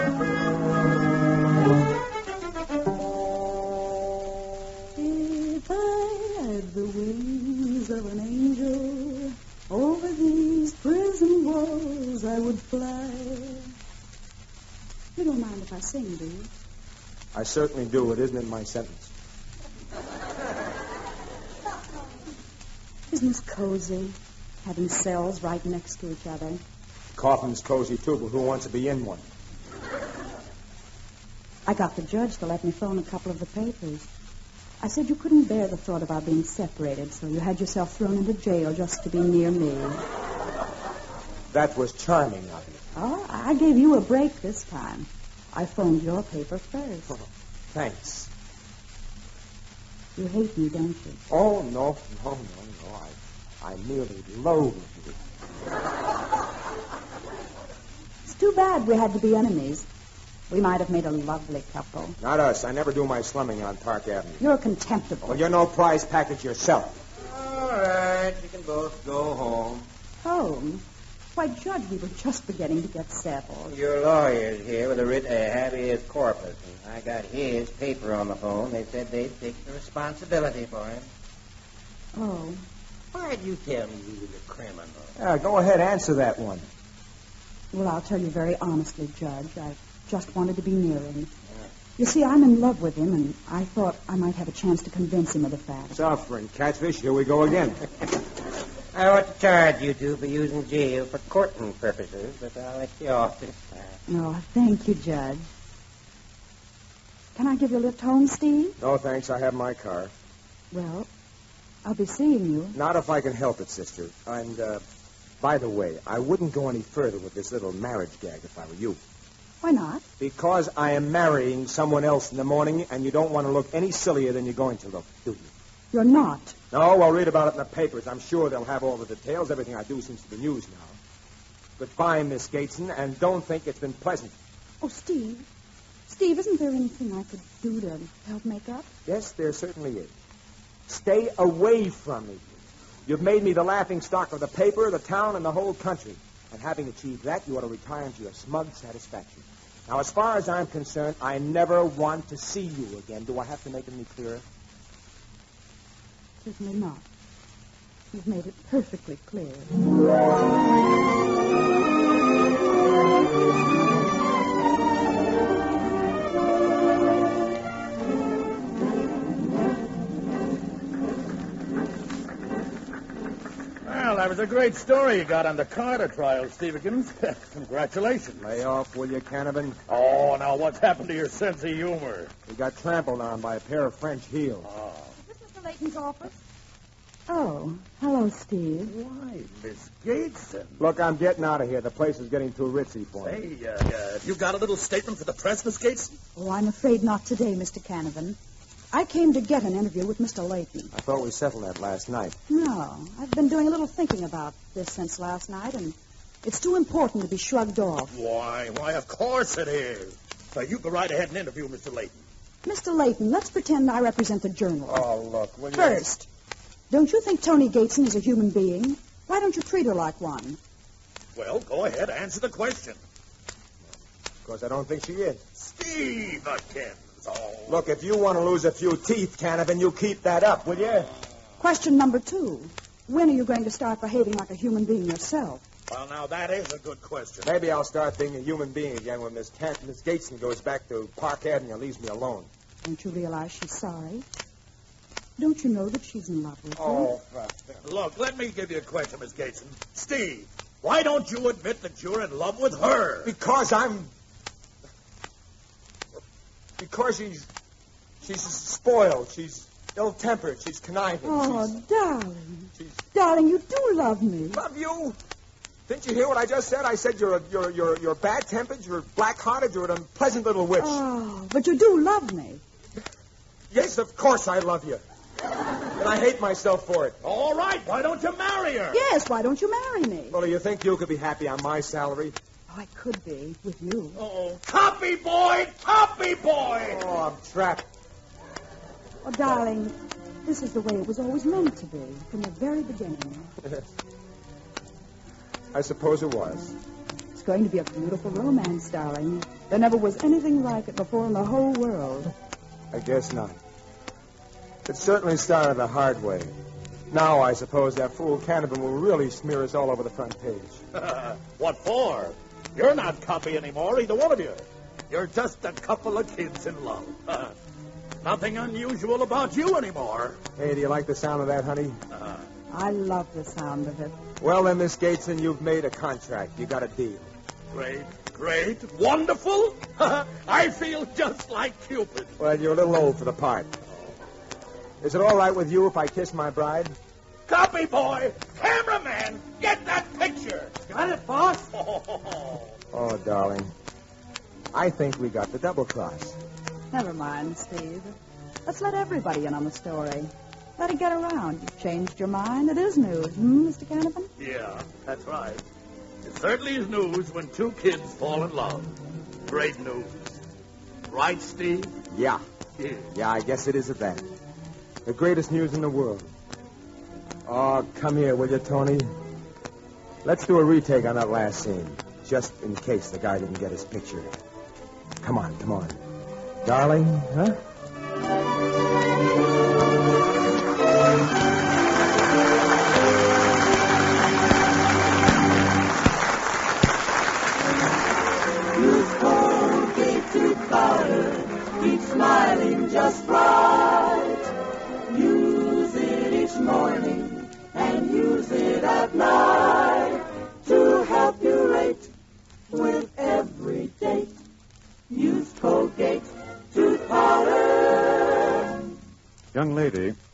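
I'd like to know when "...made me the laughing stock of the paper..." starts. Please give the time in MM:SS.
02:23.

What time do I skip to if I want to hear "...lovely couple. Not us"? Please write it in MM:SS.
01:01.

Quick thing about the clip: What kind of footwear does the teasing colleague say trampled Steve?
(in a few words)
French heels.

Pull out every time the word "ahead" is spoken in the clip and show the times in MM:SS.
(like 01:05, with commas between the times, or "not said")
01:25, 03:31, 03:41.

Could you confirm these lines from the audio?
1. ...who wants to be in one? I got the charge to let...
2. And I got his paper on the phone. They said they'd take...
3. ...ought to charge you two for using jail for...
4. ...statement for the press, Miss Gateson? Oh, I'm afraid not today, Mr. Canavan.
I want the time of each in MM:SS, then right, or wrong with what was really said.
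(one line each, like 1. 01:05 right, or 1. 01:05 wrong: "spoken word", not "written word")
1. 00:28 wrong: "judge", not "charge"
2. 01:16 right
3. 01:39 right
4. 03:14 right.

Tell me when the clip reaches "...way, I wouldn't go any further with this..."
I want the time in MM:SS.
01:55.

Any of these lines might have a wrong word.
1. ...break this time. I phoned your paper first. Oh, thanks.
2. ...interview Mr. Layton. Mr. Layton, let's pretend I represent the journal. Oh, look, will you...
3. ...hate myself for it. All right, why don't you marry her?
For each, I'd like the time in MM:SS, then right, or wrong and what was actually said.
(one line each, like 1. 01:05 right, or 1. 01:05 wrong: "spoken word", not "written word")
1. 00:44 right
2. 03:31 right
3. 04:36 right.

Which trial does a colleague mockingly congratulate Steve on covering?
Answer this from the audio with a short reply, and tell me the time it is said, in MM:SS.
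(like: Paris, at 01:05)
The Carter trial, at 02:55.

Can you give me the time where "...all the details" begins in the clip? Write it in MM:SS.
02:08.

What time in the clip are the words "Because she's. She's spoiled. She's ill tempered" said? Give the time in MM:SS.
04:16.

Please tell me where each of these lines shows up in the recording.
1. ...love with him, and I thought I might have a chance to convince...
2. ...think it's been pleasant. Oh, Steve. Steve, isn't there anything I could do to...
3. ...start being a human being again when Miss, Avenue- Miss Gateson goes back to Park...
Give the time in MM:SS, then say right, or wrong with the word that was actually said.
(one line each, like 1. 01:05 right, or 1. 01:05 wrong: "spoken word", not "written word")
1. 01:32 right
2. 02:13 right
3. 03:57 wrong: "Tan", not "Avenue".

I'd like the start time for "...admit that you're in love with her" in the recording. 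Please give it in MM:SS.
04:11.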